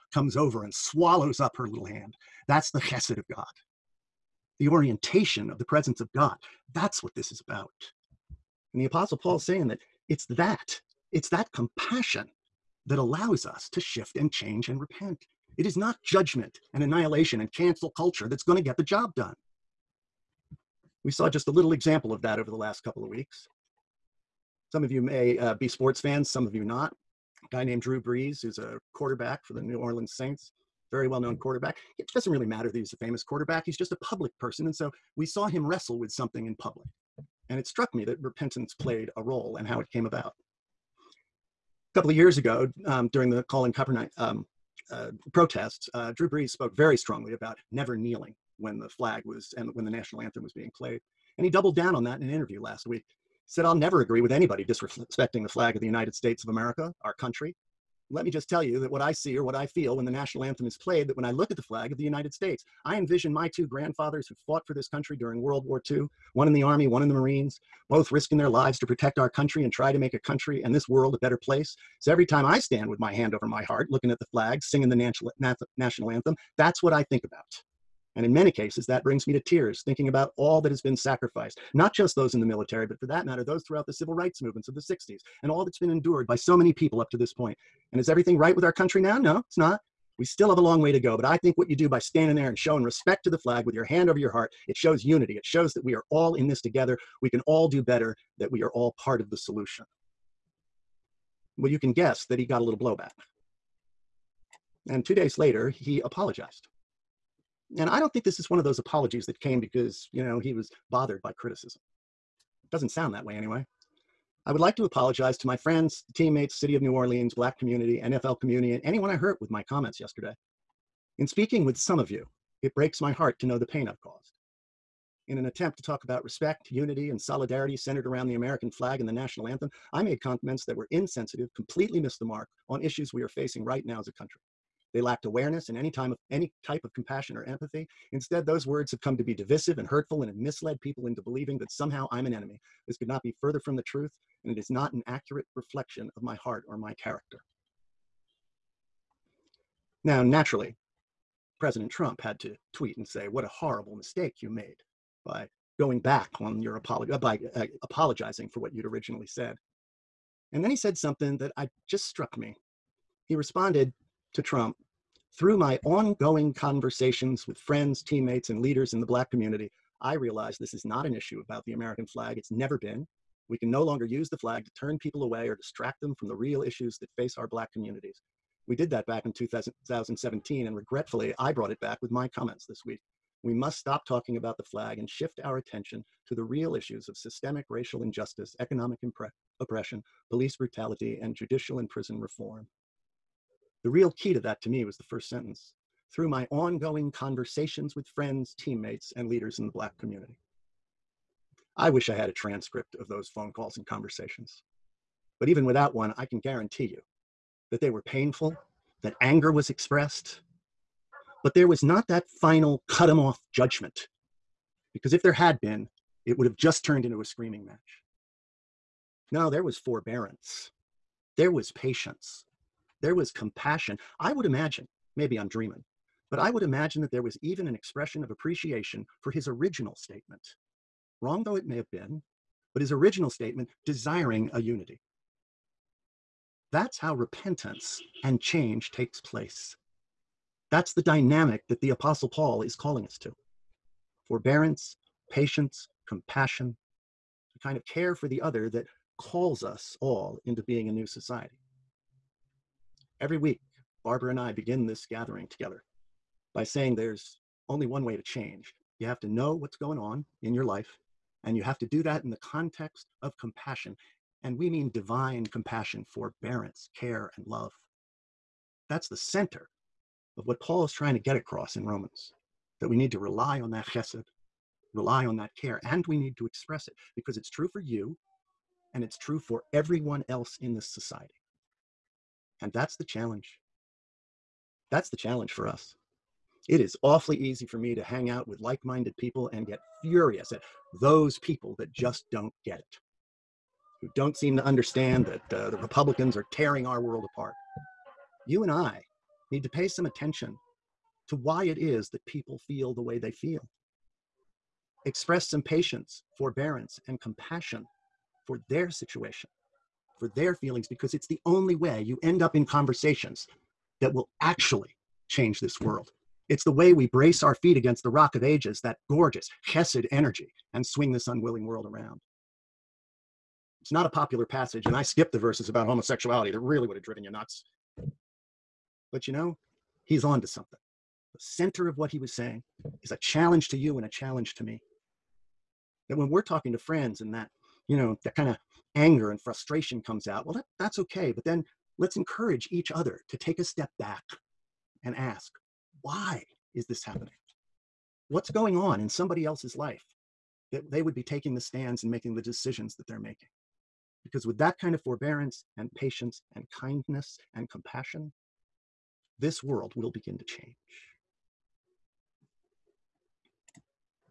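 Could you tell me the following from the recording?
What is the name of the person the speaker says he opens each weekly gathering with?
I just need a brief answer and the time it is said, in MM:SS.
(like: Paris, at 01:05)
Barbara, at 04:14.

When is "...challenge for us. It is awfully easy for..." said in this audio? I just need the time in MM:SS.
04:45.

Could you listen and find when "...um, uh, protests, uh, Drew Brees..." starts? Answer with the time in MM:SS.
00:44.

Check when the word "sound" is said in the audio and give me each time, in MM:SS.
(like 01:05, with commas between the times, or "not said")
01:52.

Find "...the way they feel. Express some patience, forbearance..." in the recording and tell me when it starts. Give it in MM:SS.
05:02.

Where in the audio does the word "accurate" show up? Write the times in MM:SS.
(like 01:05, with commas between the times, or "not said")
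02:25.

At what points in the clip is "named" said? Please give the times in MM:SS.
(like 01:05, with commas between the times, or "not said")
00:27.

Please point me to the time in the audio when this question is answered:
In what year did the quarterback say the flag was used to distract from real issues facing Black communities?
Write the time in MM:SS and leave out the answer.
02:59.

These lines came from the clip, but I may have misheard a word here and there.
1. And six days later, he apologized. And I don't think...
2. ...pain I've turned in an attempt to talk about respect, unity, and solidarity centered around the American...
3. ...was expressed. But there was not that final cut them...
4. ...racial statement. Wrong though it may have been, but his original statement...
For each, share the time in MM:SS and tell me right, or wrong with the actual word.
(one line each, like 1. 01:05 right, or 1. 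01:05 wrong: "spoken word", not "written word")
1. 01:44 wrong: "two", not "six"
2. 02:03 wrong: "caused", not "turned"
3. 03:29 right
4. 03:49 wrong: "original", not "racial".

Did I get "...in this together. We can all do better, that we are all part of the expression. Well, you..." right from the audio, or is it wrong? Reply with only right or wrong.
wrong.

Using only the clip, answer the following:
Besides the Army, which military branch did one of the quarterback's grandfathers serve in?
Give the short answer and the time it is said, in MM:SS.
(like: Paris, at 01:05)
Marines, at 01:07.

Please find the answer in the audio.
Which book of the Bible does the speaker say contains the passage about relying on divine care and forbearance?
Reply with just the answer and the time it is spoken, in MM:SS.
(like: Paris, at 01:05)
Romans, at 04:31.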